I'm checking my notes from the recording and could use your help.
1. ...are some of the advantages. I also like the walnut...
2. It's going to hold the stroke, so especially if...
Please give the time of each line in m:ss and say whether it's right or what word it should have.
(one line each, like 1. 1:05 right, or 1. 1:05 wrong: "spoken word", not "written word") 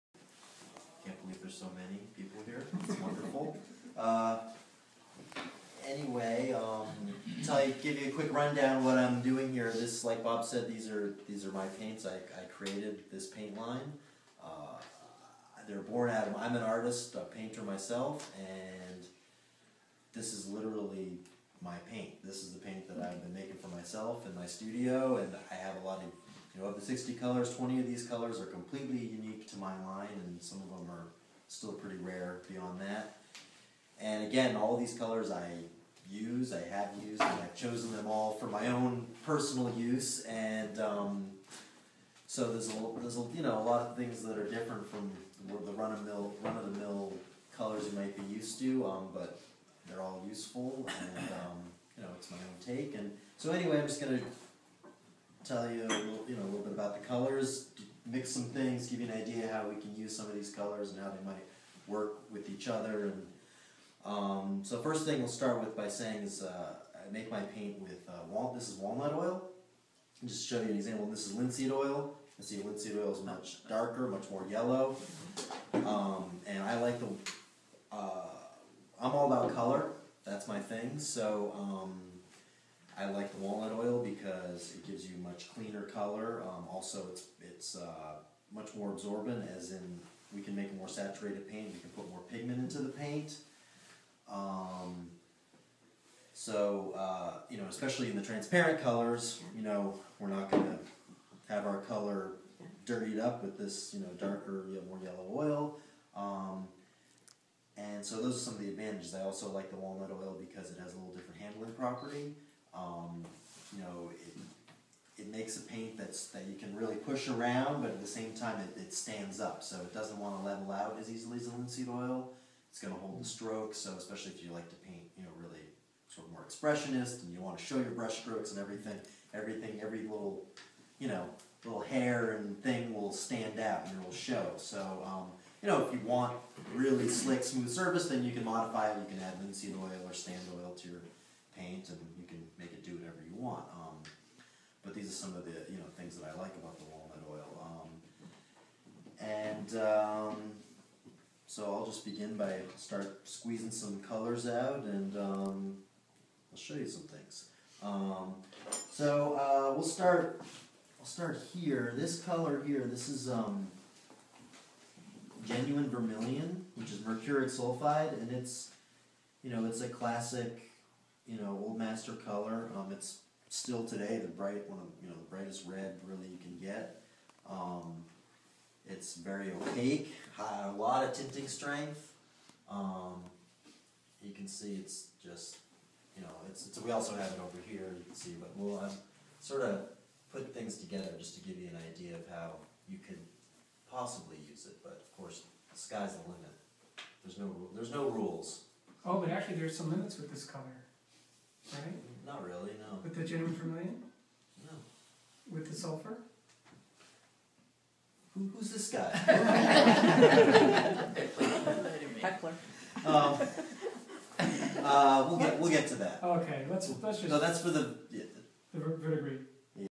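1. 1:48 right
2. 2:02 right.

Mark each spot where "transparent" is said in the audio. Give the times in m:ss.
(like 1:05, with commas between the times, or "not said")
1:38.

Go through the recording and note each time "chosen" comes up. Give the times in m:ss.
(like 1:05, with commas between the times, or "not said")
0:37.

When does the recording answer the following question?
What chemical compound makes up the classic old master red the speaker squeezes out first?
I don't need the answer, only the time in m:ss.
2:46.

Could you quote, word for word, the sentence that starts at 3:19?
Oh, but actually, there's some limits with this color right?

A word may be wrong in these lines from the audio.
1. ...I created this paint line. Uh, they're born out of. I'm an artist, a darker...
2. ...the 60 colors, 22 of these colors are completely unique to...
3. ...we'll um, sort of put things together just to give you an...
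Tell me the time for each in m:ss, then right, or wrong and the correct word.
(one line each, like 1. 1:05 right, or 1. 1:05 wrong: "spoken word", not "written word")
1. 0:12 wrong: "painter", not "darker"
2. 0:26 wrong: "20", not "22"
3. 3:08 right.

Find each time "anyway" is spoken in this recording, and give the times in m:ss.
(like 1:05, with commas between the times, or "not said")
0:05, 0:53.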